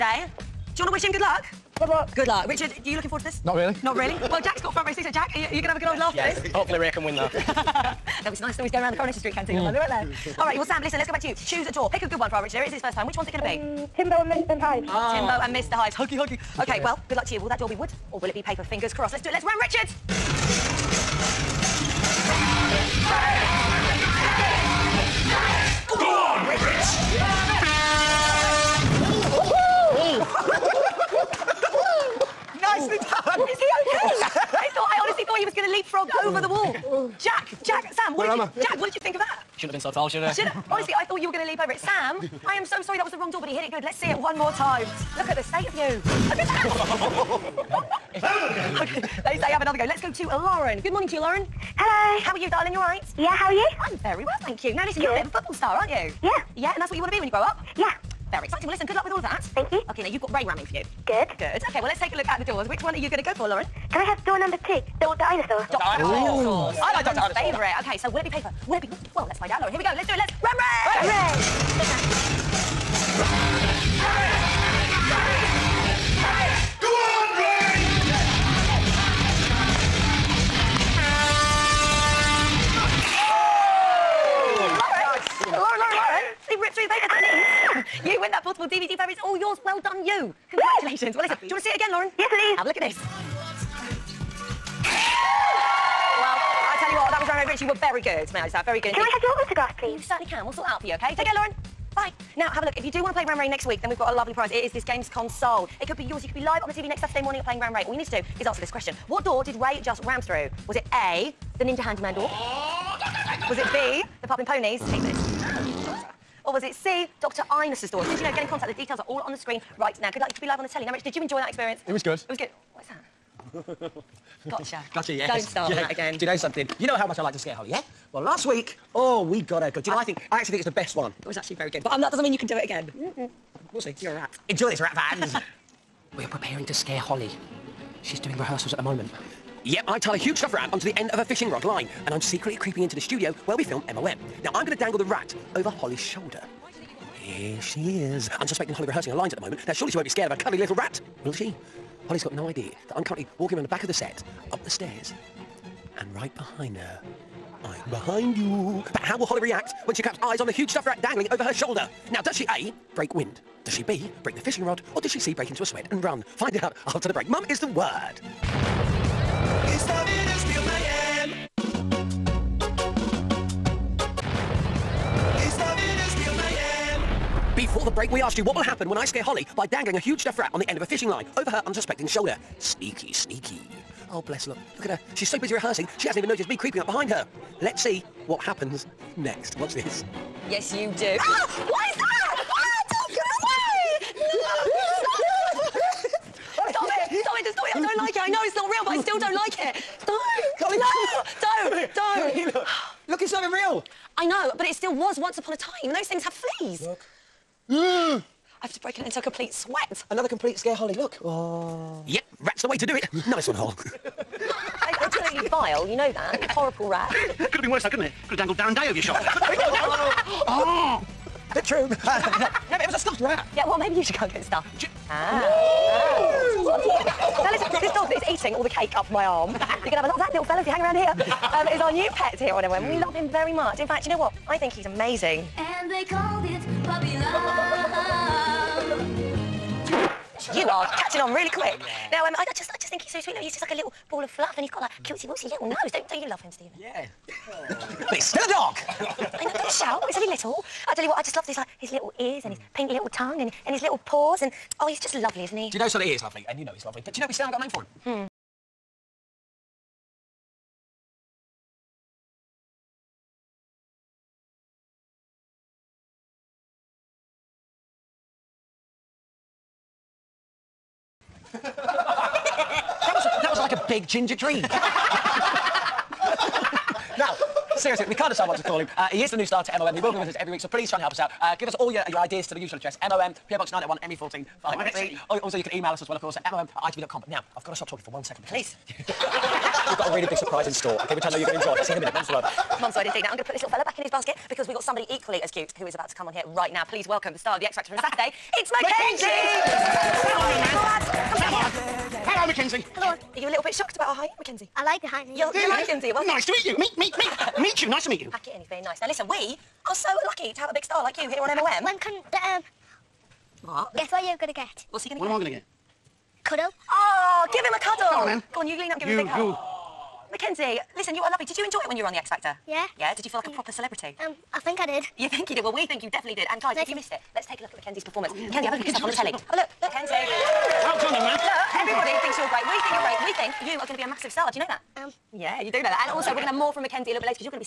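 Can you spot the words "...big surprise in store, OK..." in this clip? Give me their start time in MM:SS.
04:50.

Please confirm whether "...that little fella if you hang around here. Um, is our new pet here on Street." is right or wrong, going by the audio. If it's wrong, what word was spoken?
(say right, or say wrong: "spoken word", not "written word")
wrong: "MOM", not "Street".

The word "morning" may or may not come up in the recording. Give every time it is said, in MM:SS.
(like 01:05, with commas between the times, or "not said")
00:50, 01:47.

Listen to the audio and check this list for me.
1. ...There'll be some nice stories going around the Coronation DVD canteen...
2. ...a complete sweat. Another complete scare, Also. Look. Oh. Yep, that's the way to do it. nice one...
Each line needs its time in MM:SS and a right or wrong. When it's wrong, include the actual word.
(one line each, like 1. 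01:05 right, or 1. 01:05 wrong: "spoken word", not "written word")
1. 00:08 wrong: "Street", not "DVD"
2. 03:29 wrong: "Holly", not "Also".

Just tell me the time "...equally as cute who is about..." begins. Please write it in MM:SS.
04:55.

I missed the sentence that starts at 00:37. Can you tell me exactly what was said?
Jack, Jack, Sam, what Where did you...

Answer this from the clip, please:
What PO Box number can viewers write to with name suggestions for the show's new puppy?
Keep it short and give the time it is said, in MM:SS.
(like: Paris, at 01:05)
901, at 04:43.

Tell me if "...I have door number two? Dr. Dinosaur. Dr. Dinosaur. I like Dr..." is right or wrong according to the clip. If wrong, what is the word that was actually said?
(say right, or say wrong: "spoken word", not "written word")
right.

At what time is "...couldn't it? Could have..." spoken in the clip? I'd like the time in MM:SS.
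03:37.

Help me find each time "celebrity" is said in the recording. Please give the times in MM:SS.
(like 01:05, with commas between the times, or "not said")
05:23.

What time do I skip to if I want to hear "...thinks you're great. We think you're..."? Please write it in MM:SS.
05:32.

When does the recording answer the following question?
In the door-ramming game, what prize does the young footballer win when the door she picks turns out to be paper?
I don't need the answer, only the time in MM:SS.
01:28.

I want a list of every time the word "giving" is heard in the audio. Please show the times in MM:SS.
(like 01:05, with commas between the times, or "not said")
not said.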